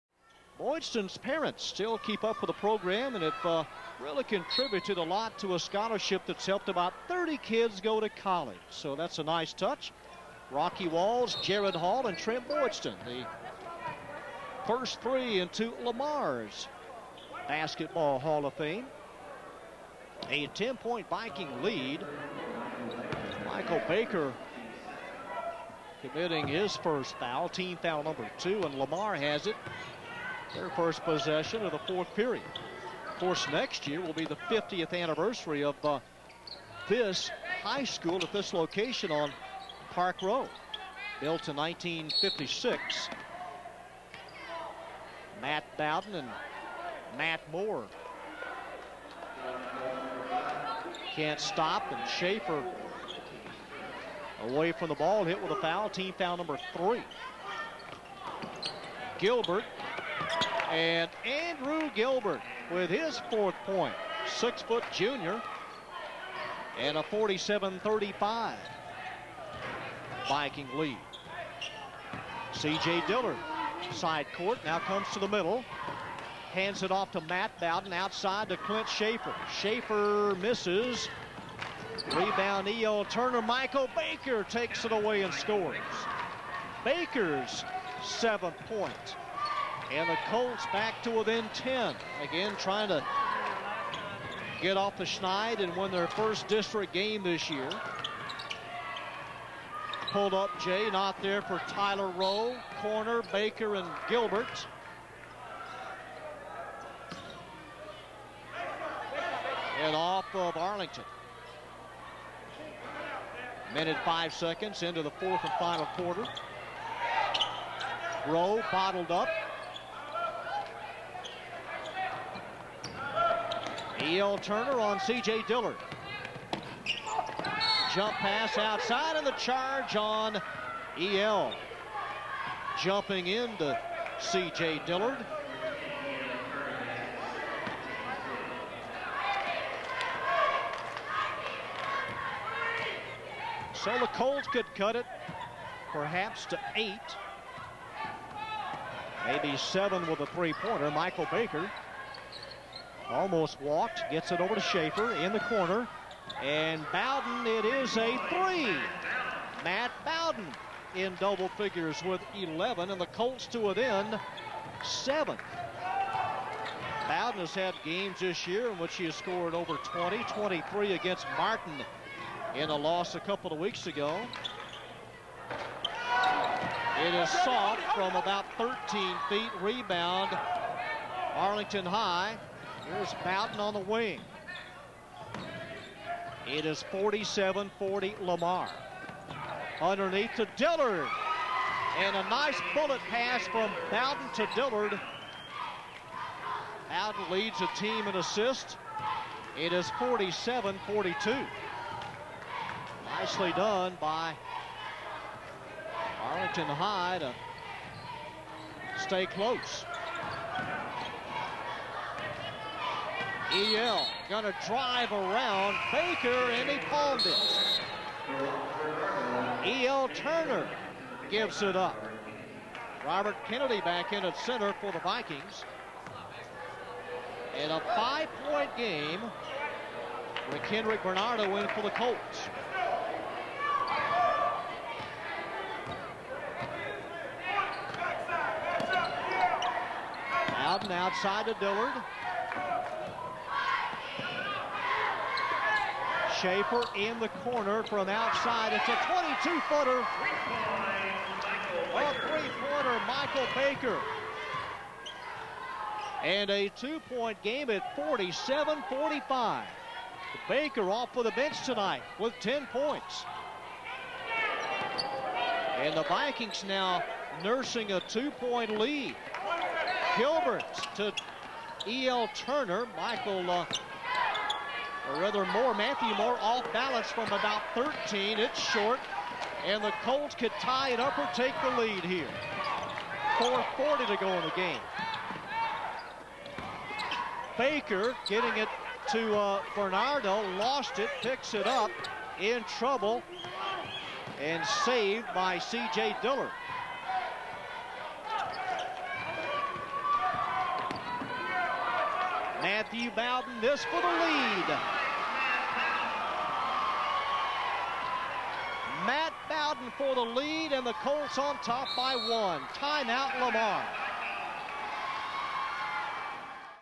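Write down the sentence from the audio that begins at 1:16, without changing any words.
Hands it off to Matt Bowden outside to Clint Schaefer.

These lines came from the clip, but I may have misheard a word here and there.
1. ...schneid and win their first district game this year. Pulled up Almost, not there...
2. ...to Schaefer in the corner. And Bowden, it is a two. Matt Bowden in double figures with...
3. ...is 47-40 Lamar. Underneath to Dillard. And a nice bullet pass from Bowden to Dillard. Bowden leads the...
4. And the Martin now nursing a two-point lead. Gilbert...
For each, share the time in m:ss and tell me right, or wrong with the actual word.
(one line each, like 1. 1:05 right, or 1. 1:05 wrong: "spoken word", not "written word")
1. 1:35 wrong: "Jay", not "Almost"
2. 2:34 wrong: "three", not "two"
3. 3:06 right
4. 4:25 wrong: "Vikings", not "Martin".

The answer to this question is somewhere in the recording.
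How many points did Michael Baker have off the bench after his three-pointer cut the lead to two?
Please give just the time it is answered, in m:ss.
4:22.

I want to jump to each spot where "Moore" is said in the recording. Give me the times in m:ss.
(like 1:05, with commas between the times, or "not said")
0:47, 4:36.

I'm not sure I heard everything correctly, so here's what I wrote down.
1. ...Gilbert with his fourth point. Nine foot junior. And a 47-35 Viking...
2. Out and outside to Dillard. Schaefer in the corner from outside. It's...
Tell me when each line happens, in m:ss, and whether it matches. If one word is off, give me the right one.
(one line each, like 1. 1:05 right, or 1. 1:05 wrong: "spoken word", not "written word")
1. 1:01 wrong: "Six", not "Nine"
2. 4:00 right.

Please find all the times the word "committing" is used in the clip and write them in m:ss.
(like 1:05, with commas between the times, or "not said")
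0:26.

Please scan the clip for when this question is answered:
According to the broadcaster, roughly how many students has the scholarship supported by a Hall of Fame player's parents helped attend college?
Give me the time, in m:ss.
0:07.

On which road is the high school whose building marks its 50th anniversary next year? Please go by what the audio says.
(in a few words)
Park Road.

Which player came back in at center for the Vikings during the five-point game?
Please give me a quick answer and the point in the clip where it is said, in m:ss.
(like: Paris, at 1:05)
Robert Kennedy, at 3:43.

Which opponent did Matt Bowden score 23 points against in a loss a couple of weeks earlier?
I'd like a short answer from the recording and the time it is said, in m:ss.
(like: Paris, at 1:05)
Martin, at 2:51.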